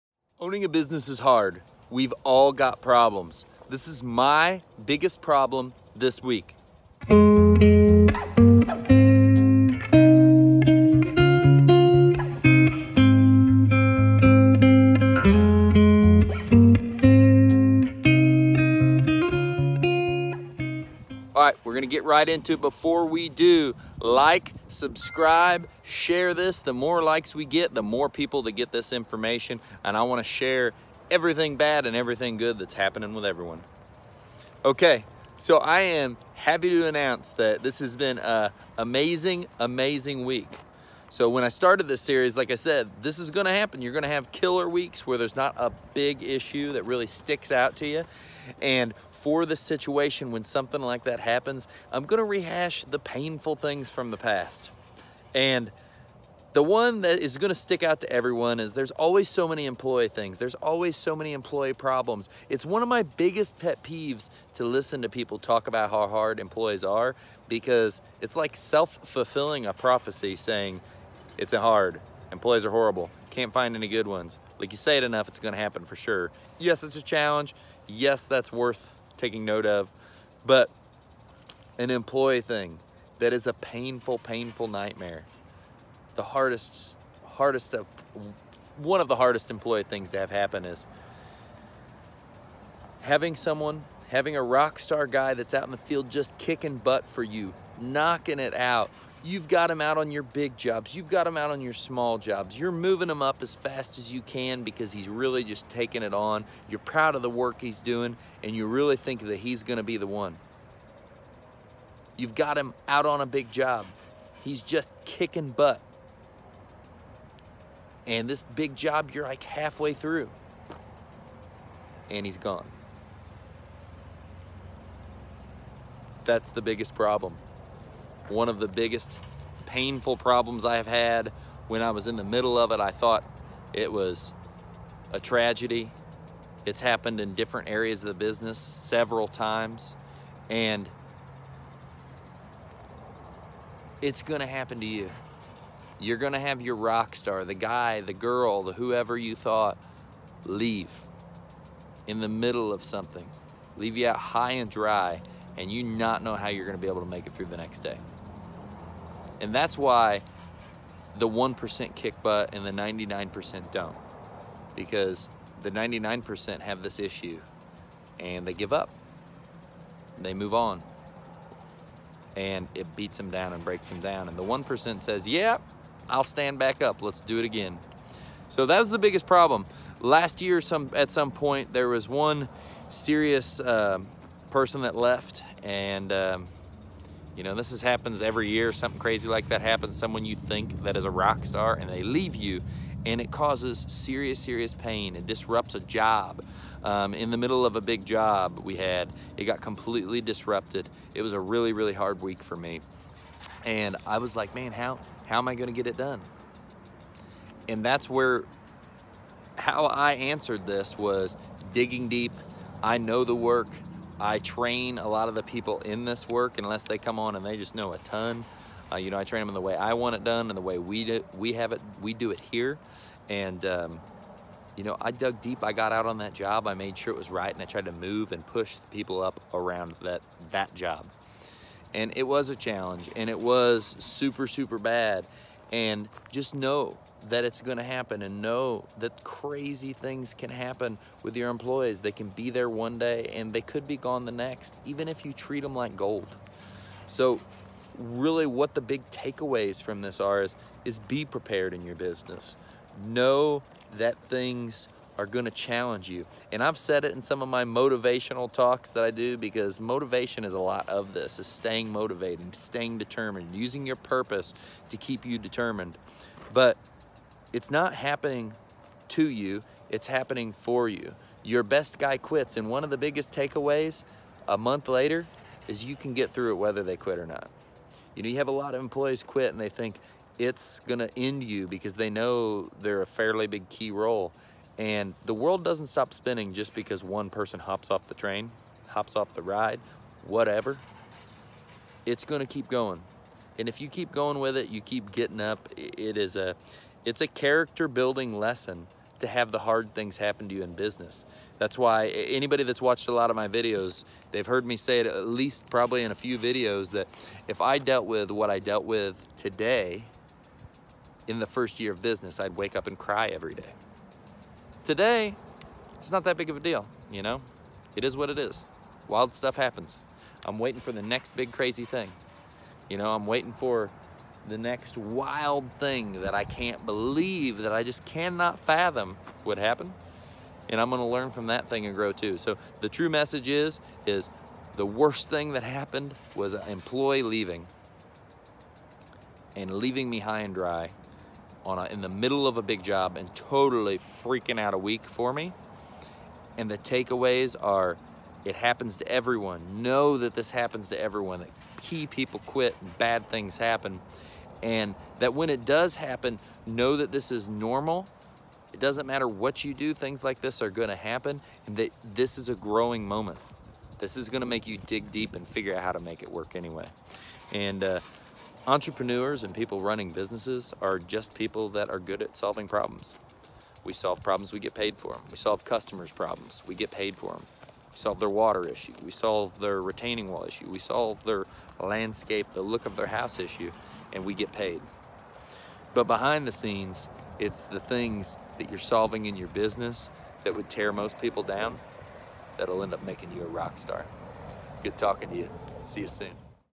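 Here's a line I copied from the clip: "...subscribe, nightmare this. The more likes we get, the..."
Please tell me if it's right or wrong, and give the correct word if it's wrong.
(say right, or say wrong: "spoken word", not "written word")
wrong: "share", not "nightmare".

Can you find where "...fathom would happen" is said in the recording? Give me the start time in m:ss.
5:28.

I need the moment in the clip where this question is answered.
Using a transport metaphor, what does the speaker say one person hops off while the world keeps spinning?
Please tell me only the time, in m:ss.
4:48.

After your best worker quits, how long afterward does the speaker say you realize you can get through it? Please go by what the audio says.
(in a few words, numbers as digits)
a month later.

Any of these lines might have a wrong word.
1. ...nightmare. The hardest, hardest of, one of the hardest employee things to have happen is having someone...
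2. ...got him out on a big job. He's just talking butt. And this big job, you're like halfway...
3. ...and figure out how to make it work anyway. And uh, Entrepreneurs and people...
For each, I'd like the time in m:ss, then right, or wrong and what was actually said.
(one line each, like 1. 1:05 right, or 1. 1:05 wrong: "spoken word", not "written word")
1. 1:24 right
2. 1:52 wrong: "kicking", not "talking"
3. 6:05 right.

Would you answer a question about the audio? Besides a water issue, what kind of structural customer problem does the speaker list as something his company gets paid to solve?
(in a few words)
retaining wall.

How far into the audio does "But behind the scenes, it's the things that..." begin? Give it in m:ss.
6:25.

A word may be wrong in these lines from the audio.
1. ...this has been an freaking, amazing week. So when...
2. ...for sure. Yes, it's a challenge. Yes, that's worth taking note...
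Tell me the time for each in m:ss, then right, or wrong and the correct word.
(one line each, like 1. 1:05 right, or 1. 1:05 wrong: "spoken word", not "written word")
1. 0:37 wrong: "amazing", not "freaking"
2. 1:15 right.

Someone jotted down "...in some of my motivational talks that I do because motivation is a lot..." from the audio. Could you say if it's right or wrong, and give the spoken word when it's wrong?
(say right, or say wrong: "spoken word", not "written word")
right.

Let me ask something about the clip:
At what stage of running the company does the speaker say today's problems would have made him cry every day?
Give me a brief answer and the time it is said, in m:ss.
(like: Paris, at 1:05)
first year, at 5:11.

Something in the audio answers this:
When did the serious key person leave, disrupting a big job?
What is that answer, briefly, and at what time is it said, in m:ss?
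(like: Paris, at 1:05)
Last year, at 2:59.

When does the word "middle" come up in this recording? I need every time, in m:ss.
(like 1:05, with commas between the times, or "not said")
2:12, 2:32, 3:17, 5:42.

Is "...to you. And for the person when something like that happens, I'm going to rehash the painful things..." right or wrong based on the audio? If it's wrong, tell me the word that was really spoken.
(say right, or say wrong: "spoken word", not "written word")
wrong: "situation", not "person".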